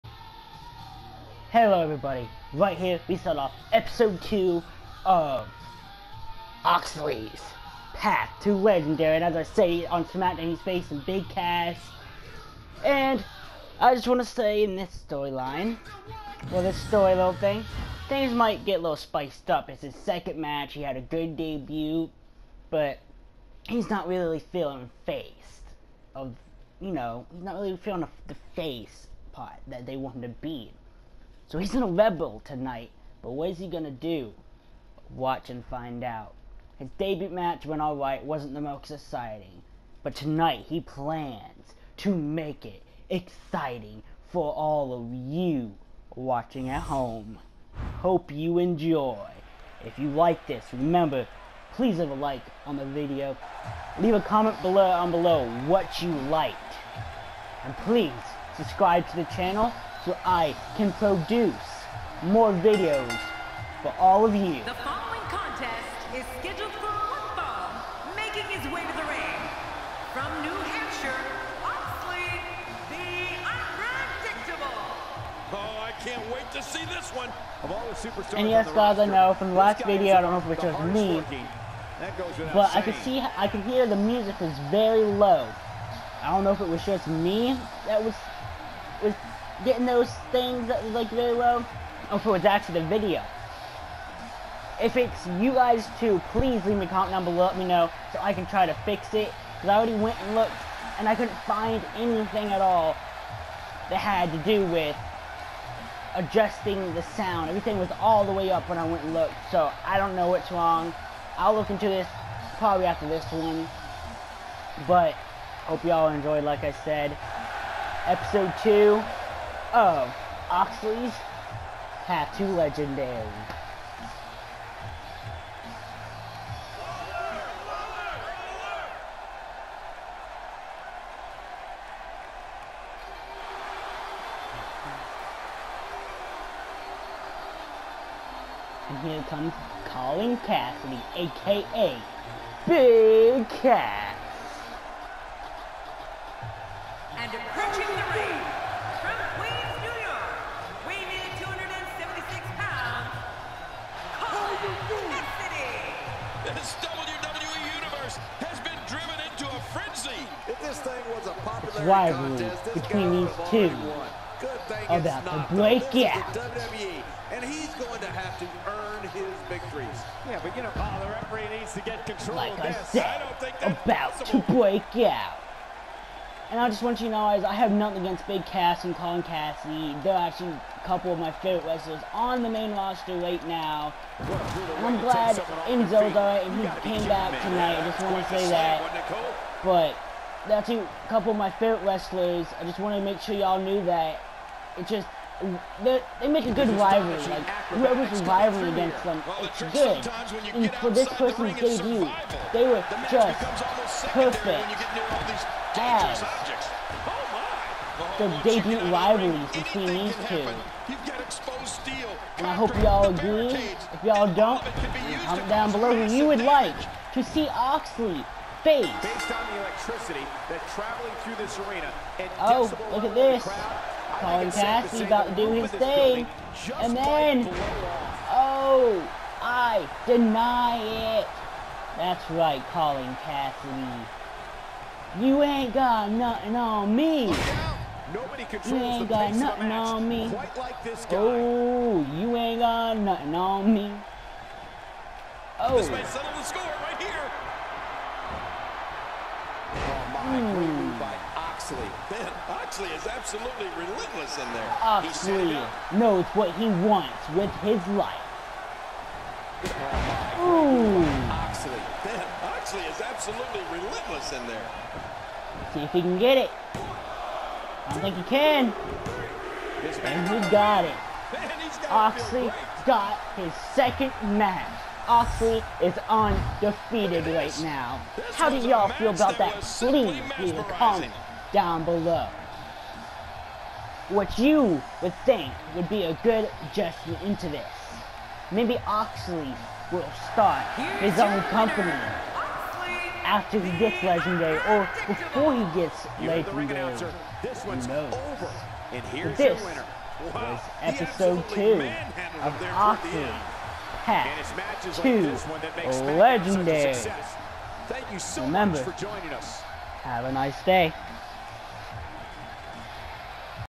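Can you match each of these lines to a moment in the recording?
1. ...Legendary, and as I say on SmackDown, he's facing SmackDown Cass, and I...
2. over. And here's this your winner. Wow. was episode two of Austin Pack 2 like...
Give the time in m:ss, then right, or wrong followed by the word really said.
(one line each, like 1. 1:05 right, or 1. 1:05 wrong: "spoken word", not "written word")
1. 0:08 wrong: "Big", not "SmackDown"
2. 4:58 right.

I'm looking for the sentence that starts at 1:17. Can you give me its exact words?
Of all the superstars and yes, guys, I know from the last video, I don't know if it was me, but saying.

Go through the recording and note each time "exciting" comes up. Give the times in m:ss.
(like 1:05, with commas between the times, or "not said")
0:38, 0:43.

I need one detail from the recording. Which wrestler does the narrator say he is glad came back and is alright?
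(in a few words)
Enzo.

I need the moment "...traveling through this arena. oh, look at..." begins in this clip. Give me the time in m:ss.
3:40.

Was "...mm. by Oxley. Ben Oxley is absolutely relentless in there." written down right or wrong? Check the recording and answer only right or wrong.
right.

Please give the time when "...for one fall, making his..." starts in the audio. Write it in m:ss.
1:06.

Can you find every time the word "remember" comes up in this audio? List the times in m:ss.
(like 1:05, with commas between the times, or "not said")
0:50, 5:08.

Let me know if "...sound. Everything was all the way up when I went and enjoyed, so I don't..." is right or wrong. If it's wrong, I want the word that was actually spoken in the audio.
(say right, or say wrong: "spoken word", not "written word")
wrong: "looked", not "enjoyed".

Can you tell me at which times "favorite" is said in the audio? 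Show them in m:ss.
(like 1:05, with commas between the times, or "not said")
3:01, 3:11.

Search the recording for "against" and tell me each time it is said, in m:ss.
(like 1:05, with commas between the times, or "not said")
2:58, 3:18.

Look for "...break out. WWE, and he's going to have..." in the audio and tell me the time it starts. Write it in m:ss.
2:45.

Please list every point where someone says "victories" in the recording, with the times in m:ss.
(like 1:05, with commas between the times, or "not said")
2:49.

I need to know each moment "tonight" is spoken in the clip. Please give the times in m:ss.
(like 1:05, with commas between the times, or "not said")
0:32, 0:40, 3:07.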